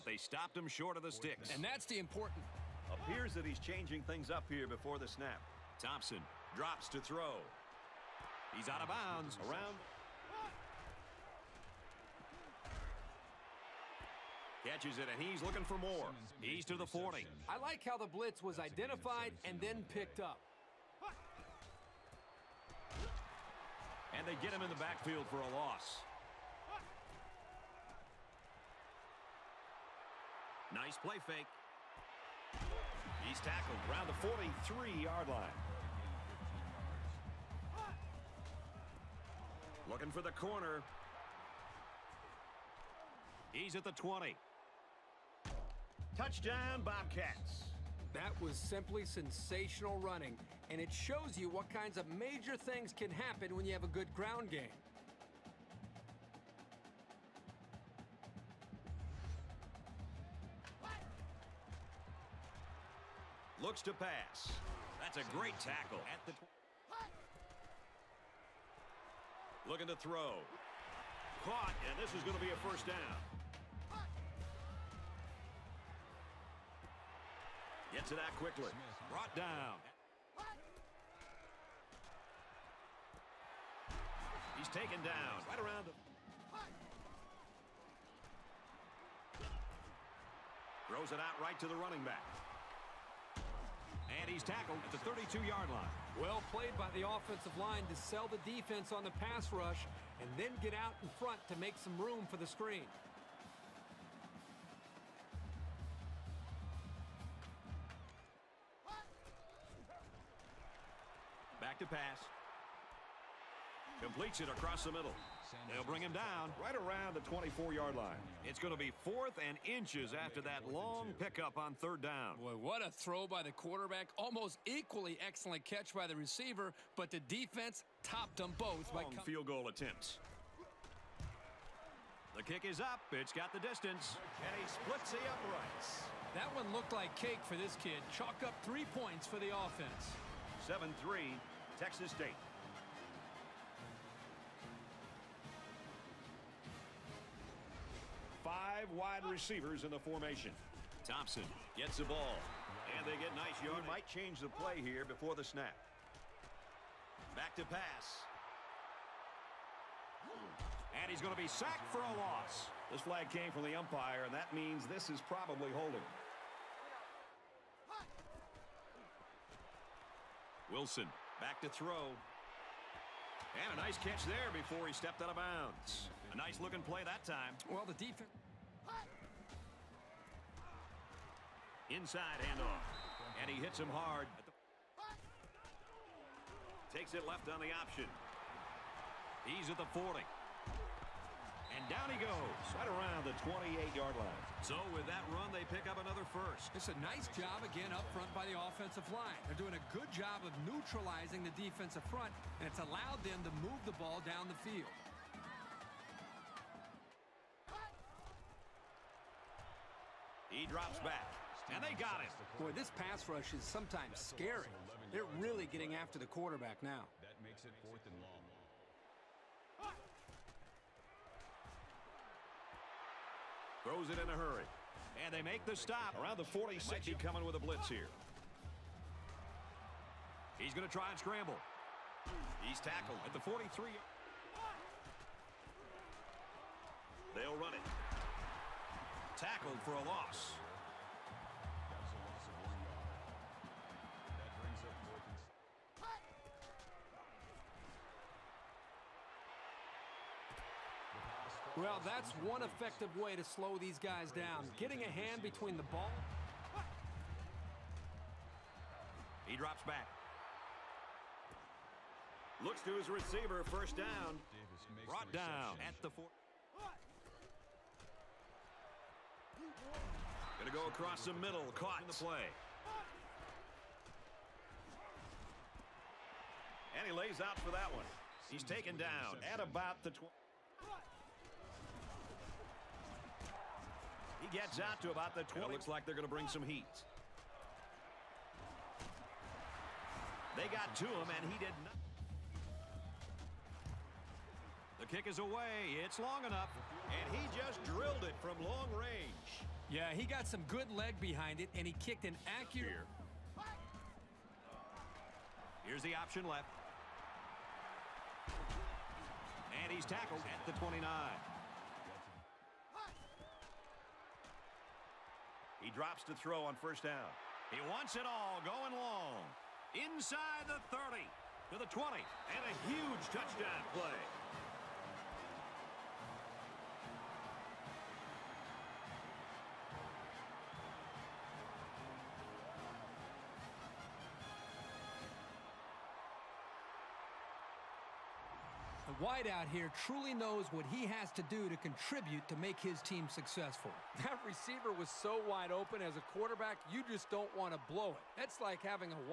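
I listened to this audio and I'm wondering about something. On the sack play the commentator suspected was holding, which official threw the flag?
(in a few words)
umpire.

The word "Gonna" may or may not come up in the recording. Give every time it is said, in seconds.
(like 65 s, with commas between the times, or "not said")
270 s.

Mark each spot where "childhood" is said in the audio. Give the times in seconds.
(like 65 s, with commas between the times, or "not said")
not said.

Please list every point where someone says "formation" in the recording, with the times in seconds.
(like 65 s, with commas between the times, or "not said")
149 s.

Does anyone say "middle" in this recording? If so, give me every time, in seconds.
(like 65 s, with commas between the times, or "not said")
114 s, 271 s.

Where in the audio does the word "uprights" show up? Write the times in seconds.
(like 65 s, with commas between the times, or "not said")
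135 s.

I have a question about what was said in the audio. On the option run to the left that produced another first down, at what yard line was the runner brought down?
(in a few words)
28.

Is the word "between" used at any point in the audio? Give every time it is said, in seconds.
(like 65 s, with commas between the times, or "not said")
255 s.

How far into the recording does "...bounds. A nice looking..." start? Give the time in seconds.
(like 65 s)
175 s.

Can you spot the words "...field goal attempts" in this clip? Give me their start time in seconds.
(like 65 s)
129 s.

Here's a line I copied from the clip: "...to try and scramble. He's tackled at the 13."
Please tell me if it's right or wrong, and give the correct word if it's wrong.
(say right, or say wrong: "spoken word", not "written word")
wrong: "43", not "13".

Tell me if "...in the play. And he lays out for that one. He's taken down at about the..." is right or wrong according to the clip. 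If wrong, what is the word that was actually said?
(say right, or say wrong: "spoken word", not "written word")
right.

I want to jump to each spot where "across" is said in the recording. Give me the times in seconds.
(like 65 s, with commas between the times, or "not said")
114 s, 270 s.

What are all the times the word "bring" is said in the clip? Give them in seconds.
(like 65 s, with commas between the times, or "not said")
115 s, 286 s.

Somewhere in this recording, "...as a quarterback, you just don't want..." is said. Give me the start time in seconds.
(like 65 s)
346 s.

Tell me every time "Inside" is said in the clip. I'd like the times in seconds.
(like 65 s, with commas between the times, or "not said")
181 s, 319 s.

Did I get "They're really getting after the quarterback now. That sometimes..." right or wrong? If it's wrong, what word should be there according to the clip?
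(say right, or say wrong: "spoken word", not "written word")
wrong: "makes", not "sometimes".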